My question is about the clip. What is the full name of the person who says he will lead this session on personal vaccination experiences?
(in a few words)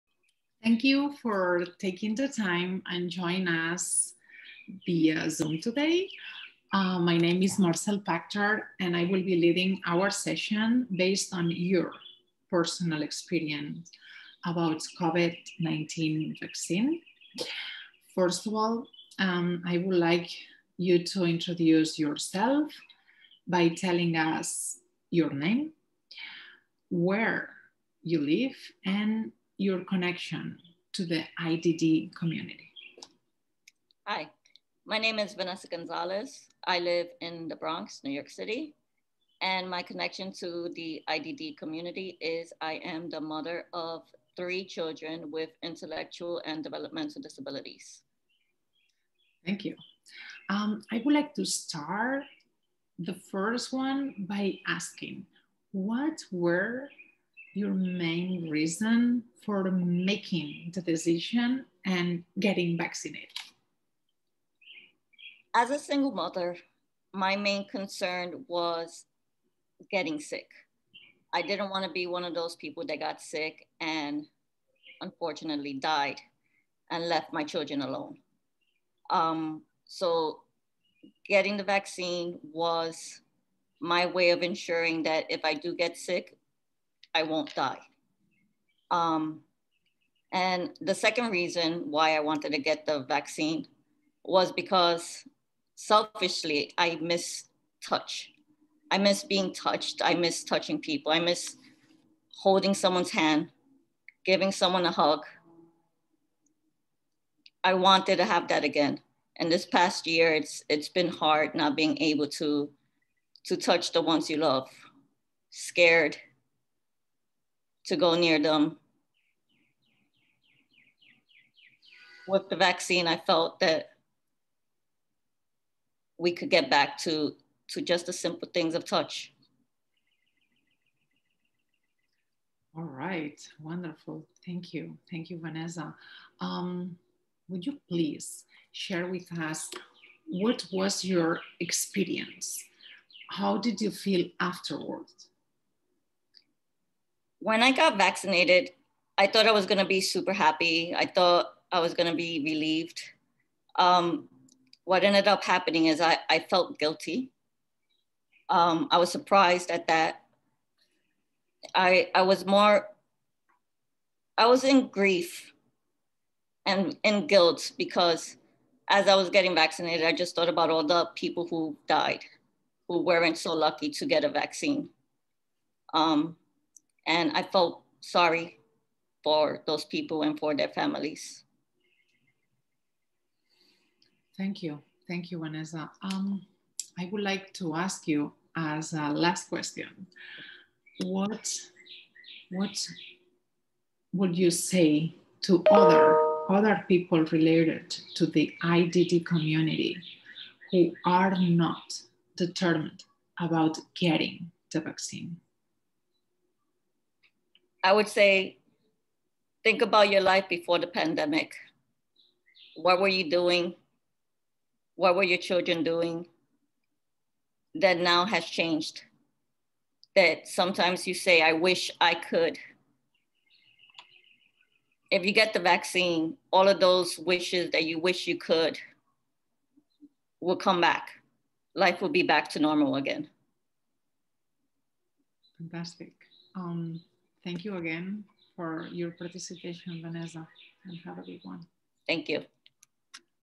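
Marcel Pachter.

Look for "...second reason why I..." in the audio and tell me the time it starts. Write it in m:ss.
1:30.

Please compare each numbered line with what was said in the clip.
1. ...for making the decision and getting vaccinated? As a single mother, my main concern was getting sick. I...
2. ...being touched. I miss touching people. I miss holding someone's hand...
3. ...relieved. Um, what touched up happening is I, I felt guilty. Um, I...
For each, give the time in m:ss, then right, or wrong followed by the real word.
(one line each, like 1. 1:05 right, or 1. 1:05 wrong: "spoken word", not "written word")
1. 0:59 right
2. 1:39 right
3. 2:32 wrong: "ended", not "touched".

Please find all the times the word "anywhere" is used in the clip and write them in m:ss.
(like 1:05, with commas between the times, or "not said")
not said.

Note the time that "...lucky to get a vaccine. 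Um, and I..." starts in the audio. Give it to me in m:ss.
2:53.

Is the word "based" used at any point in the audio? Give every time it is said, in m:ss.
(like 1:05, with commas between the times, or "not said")
0:10.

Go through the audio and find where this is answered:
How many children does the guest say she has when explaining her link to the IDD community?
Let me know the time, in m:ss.
0:44.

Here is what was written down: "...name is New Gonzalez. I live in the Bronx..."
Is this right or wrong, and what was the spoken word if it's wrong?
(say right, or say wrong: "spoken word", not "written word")
wrong: "Vanessa", not "New".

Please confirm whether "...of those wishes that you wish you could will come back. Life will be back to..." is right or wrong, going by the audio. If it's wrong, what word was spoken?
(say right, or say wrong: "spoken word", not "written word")
right.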